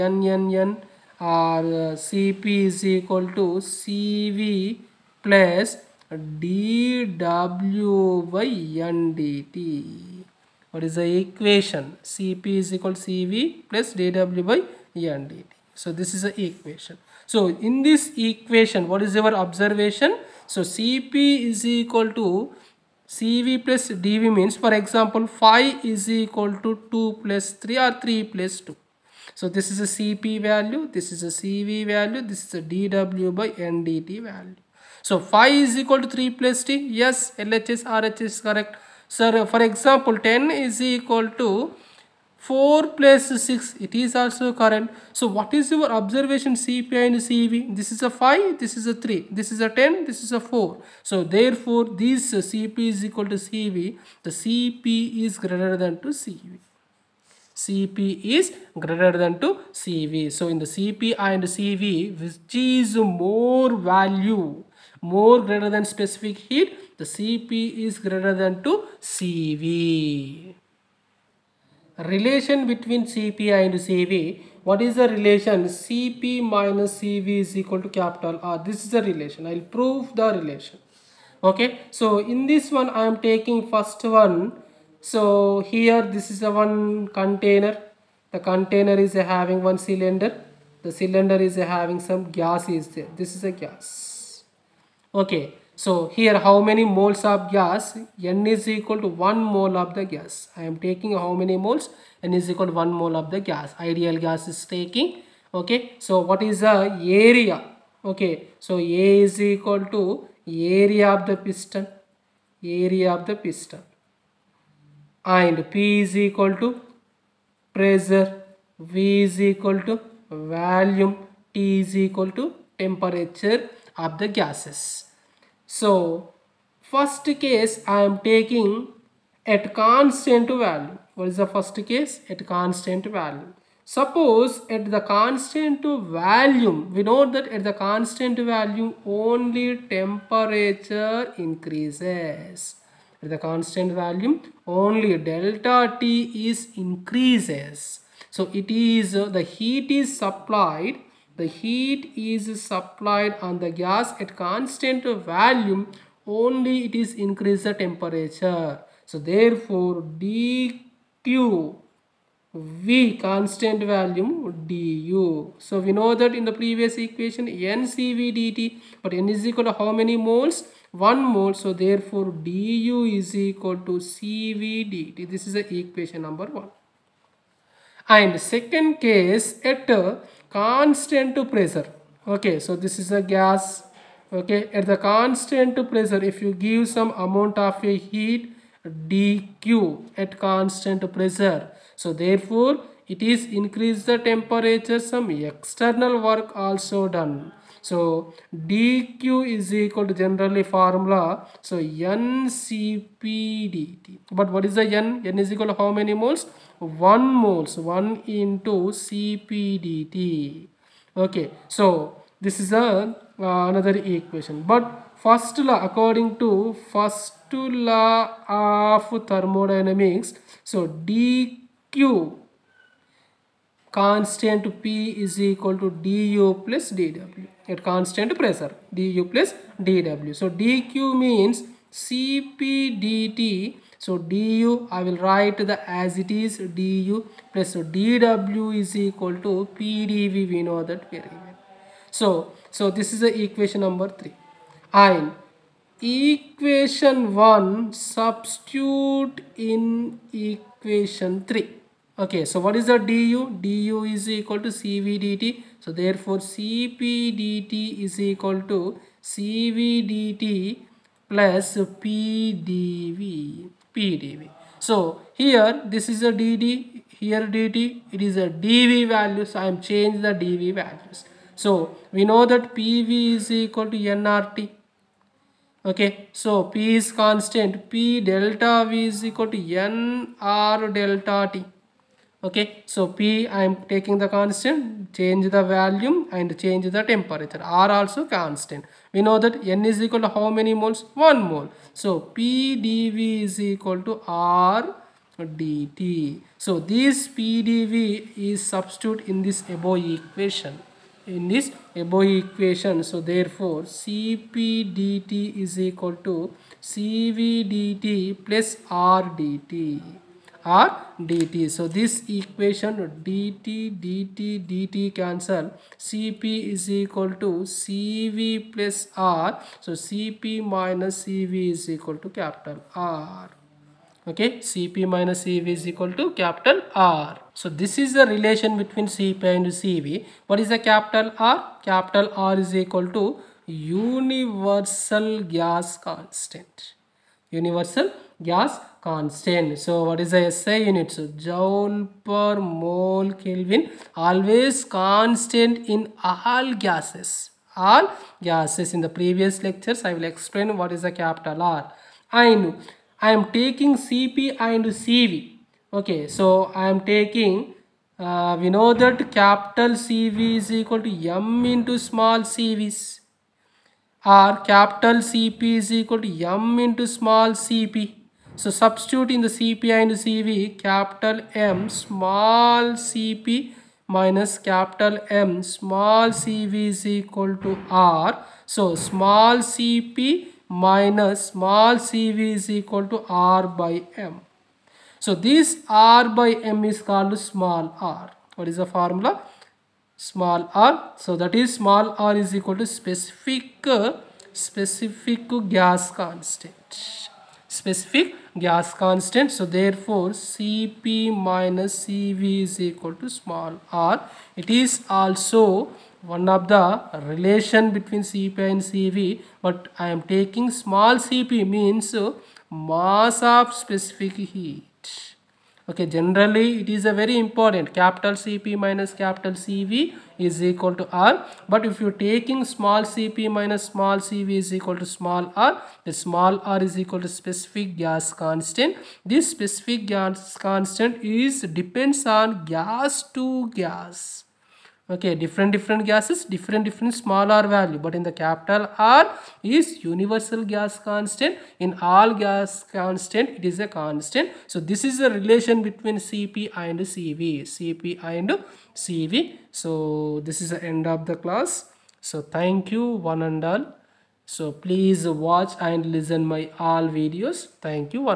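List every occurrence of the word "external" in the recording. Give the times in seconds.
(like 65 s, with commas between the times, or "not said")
195 s.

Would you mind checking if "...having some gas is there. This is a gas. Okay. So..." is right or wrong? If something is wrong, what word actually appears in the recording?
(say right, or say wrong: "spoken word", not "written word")
right.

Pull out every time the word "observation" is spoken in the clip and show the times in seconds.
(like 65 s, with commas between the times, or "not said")
19 s, 45 s.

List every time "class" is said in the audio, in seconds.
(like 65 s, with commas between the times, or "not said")
451 s.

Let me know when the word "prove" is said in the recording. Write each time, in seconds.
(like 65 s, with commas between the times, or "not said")
79 s.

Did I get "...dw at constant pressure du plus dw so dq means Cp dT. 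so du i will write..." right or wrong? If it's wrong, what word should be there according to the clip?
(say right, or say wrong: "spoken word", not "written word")
right.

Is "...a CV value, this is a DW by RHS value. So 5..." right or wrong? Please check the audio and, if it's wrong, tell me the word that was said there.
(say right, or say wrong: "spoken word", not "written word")
wrong: "NDT", not "RHS".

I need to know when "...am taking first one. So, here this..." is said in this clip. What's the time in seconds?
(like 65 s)
83 s.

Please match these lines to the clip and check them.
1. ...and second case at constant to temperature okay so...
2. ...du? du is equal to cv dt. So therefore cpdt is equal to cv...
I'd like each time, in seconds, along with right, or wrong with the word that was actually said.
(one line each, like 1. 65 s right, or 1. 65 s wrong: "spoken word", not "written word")
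1. 178 s wrong: "pressure", not "temperature"
2. 252 s right.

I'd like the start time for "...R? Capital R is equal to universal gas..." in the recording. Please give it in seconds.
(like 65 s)
331 s.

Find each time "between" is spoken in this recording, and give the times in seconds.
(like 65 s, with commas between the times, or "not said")
72 s, 328 s, 407 s, 445 s.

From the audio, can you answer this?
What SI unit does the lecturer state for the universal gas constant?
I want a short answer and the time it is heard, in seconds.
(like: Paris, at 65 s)
joule per mole Kelvin, at 341 s.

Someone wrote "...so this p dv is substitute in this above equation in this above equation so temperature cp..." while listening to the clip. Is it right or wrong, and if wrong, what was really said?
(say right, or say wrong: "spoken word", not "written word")
wrong: "therefore", not "temperature".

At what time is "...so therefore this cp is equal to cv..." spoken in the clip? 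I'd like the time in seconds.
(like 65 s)
51 s.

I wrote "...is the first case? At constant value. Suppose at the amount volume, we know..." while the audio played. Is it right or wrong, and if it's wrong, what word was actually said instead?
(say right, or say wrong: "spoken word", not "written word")
wrong: "constant", not "amount".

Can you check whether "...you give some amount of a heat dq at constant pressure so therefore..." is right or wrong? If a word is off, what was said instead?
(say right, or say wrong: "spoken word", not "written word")
right.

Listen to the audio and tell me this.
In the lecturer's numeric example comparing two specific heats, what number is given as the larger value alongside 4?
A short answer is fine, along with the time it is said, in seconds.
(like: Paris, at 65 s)
10, at 40 s.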